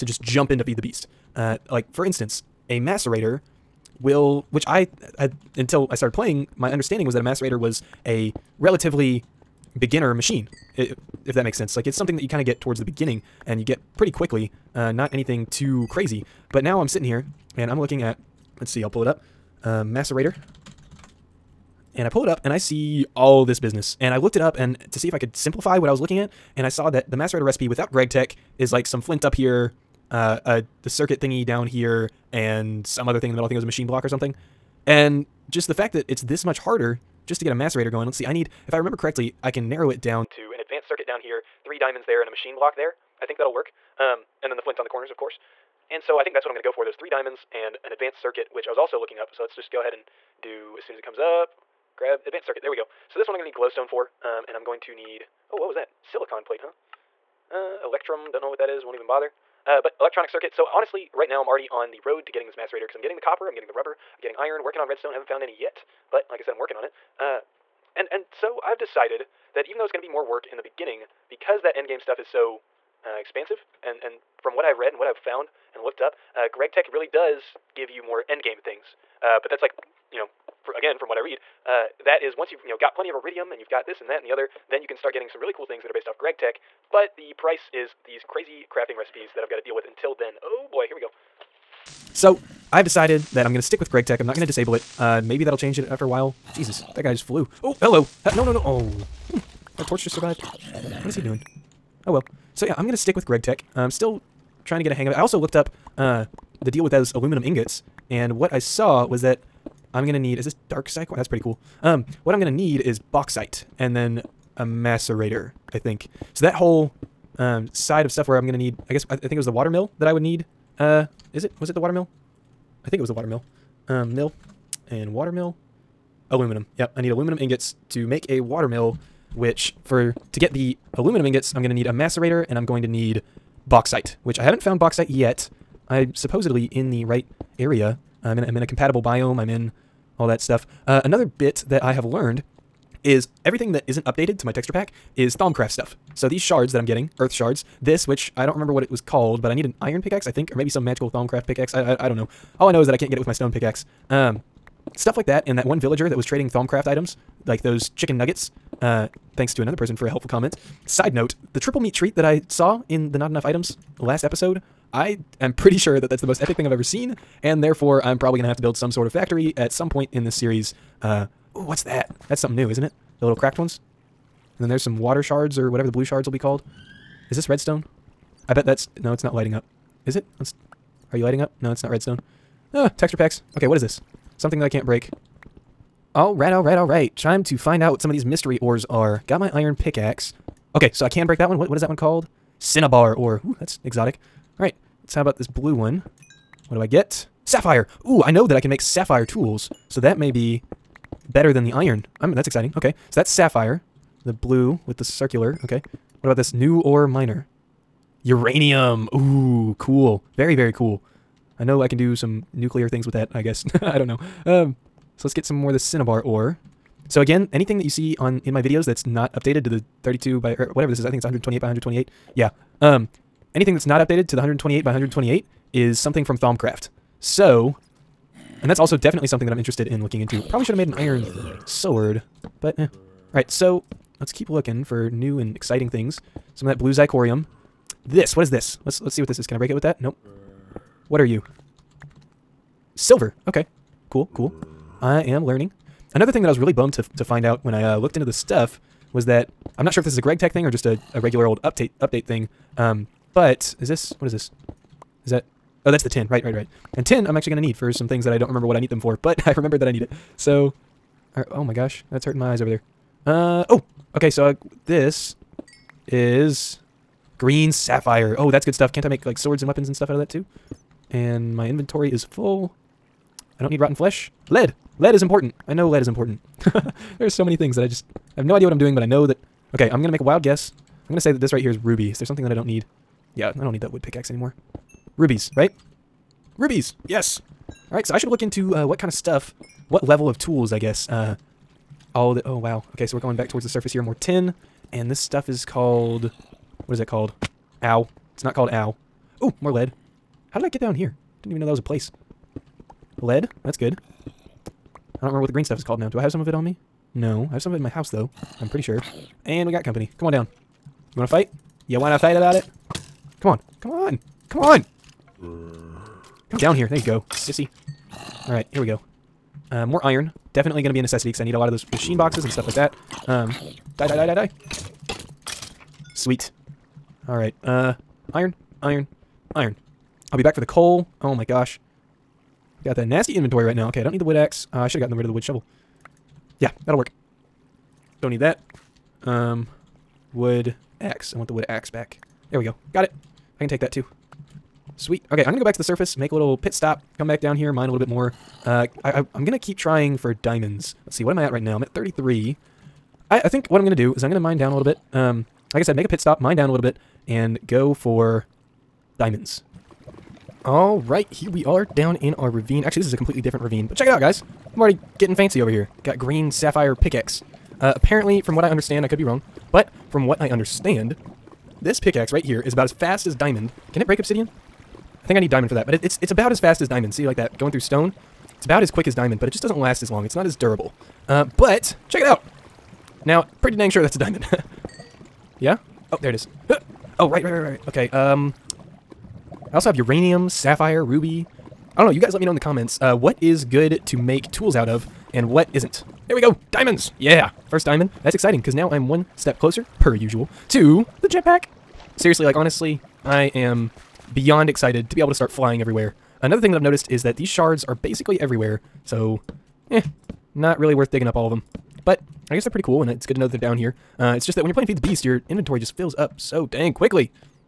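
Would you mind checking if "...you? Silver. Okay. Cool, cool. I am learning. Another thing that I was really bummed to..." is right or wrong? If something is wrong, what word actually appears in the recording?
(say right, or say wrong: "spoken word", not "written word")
right.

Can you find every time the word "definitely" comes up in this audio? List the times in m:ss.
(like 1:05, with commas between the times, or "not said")
3:48, 5:20.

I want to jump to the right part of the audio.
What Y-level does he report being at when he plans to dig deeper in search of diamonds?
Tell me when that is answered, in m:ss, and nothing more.
5:51.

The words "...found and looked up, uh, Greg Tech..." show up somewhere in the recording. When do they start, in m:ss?
1:15.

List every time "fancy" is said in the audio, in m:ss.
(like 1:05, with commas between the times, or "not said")
6:05.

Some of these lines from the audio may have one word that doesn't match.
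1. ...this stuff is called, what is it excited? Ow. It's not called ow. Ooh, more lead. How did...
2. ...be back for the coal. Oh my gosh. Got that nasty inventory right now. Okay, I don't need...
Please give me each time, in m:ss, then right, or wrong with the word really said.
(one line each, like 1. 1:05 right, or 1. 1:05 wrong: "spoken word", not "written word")
1. 4:55 wrong: "called", not "excited"
2. 5:30 right.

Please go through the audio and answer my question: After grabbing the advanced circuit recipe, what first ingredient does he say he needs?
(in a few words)
Glowstone.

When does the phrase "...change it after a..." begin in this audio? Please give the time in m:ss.
1:35.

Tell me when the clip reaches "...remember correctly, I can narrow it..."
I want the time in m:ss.
0:38.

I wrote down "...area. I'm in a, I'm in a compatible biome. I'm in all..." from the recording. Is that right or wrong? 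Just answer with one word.
right.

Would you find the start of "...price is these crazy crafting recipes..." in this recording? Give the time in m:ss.
1:27.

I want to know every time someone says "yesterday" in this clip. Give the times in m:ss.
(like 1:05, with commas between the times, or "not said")
not said.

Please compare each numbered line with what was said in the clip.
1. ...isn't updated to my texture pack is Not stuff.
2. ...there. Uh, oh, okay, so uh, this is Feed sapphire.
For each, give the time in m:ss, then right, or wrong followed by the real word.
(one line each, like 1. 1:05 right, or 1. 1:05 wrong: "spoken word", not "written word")
1. 2:23 wrong: "Thaumcraft", not "Not"
2. 4:22 wrong: "Green", not "Feed".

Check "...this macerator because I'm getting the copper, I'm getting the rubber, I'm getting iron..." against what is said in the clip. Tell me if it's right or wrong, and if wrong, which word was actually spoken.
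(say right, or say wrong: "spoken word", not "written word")
right.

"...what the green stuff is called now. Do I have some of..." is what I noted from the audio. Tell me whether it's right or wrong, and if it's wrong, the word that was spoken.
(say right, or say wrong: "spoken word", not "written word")
right.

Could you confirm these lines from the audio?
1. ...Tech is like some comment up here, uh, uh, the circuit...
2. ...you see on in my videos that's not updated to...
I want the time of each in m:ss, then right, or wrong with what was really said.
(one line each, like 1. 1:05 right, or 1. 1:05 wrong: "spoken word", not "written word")
1. 0:28 wrong: "flint", not "comment"
2. 3:37 right.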